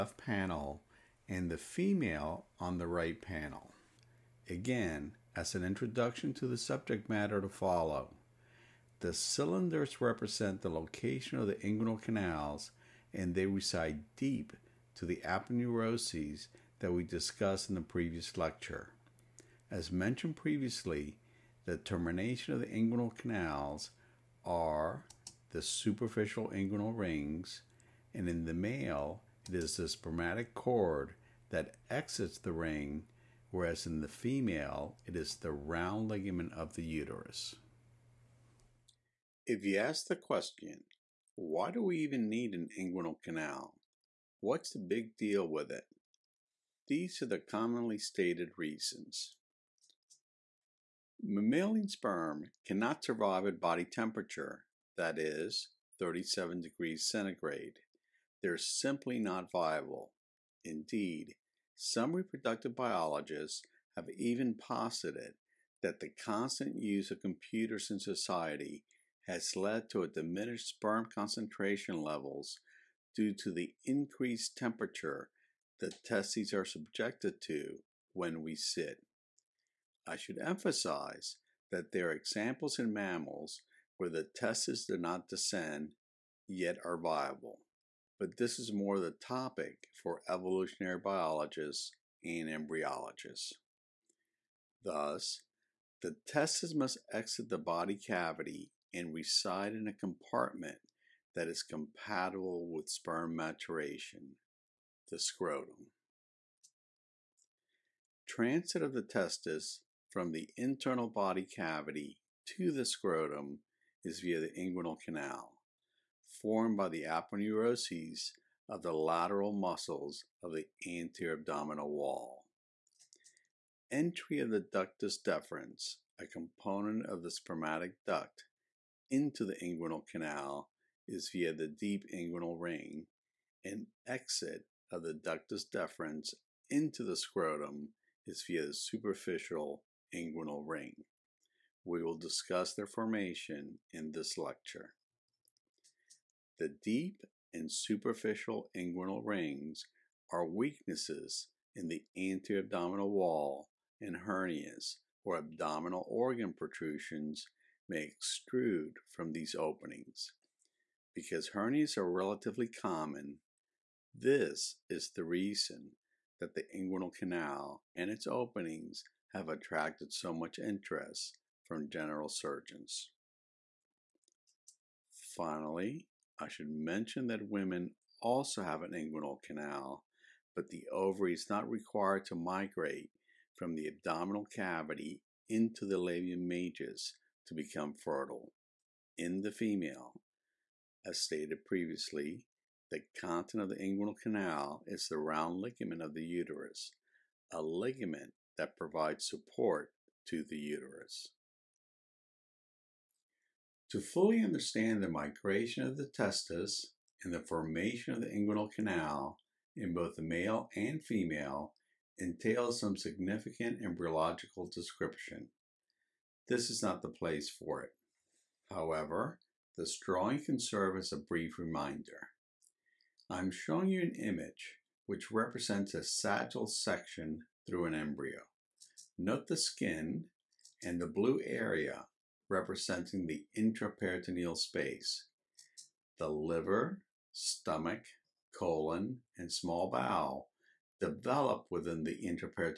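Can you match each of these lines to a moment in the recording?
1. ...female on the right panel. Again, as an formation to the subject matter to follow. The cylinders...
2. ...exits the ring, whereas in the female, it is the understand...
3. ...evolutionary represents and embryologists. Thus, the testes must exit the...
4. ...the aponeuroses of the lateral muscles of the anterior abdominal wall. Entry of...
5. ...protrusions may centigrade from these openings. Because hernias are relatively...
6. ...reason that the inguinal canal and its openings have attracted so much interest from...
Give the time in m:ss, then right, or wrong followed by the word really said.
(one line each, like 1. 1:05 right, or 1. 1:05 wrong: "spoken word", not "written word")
1. 0:01 wrong: "introduction", not "formation"
2. 0:31 wrong: "round", not "understand"
3. 1:30 wrong: "biologists", not "represents"
4. 1:56 right
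5. 2:36 wrong: "extrude", not "centigrade"
6. 2:45 right.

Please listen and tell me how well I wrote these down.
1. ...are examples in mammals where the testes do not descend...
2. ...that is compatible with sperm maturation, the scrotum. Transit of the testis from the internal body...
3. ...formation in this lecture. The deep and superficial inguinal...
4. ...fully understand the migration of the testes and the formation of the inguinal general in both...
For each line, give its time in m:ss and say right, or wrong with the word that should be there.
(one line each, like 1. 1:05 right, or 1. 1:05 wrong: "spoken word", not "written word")
1. 1:22 right
2. 1:41 right
3. 2:22 right
4. 3:23 wrong: "canal", not "general".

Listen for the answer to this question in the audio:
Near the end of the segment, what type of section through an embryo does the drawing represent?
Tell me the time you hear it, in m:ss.
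3:46.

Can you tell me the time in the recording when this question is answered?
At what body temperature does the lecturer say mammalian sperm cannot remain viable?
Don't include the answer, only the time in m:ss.
0:55.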